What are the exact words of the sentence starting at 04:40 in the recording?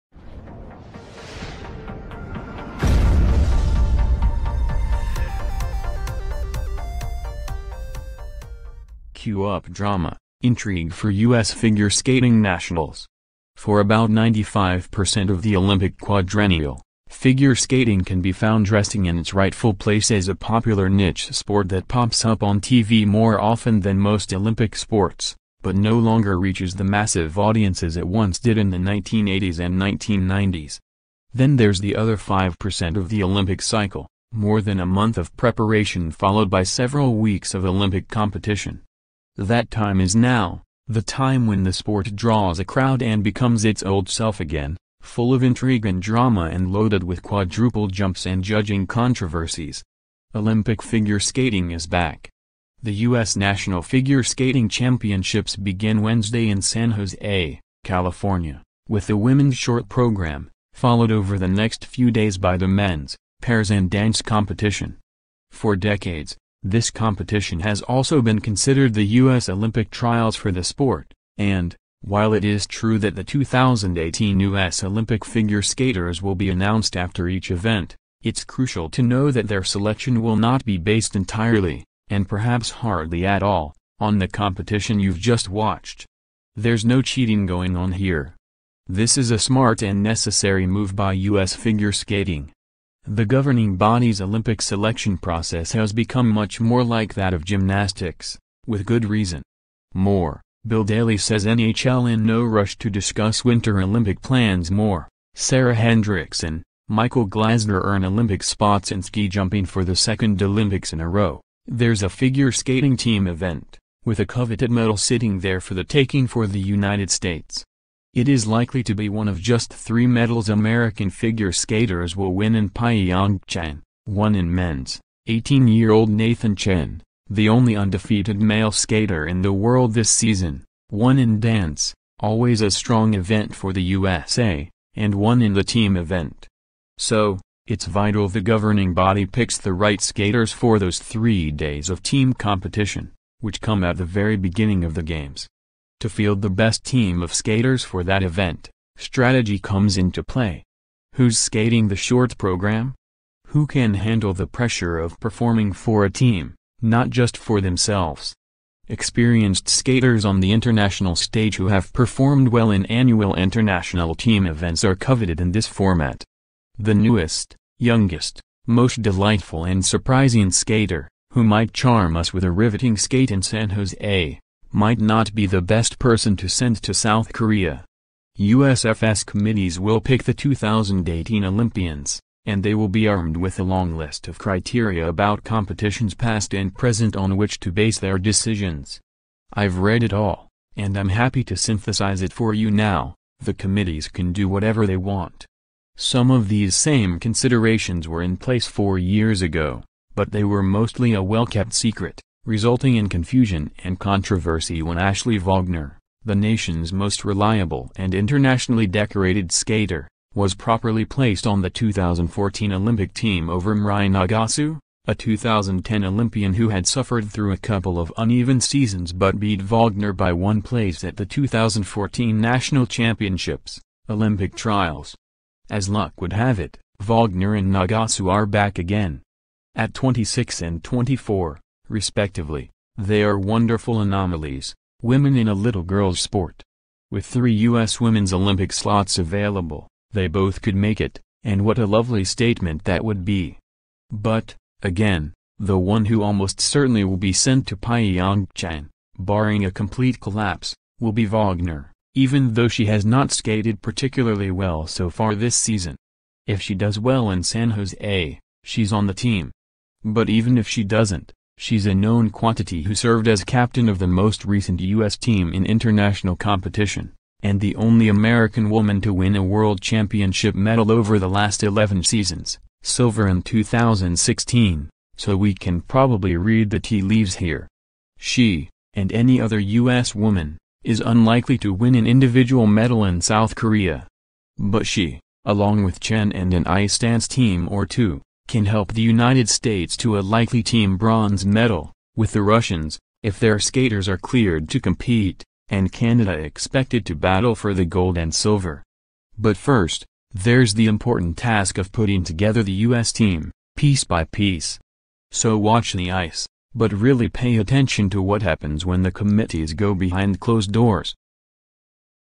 woman, is unlikely to win an individual medal in South Korea.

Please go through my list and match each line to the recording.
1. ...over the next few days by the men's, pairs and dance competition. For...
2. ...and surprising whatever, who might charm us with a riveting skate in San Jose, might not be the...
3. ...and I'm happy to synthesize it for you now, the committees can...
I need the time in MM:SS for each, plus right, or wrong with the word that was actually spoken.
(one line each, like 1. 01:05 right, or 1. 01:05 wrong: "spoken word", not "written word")
1. 01:01 right
2. 02:49 wrong: "skater", not "whatever"
3. 03:10 right.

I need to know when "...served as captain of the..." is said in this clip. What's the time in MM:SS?
04:22.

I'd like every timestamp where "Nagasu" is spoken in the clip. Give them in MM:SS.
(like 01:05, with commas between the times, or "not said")
03:34, 03:47.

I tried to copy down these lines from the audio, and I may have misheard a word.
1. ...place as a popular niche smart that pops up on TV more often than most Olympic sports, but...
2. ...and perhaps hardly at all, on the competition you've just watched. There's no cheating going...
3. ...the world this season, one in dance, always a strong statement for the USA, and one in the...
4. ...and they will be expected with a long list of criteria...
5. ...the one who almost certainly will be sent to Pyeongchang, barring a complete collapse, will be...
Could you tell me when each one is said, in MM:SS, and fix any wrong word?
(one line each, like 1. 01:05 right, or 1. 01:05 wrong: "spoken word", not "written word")
1. 00:19 wrong: "sport", not "smart"
2. 01:22 right
3. 02:09 wrong: "event", not "statement"
4. 03:02 wrong: "armed", not "expected"
5. 04:05 right.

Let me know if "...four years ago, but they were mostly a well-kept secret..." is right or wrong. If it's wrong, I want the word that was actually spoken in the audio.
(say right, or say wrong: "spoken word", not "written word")
right.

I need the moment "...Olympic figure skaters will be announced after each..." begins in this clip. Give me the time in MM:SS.
01:14.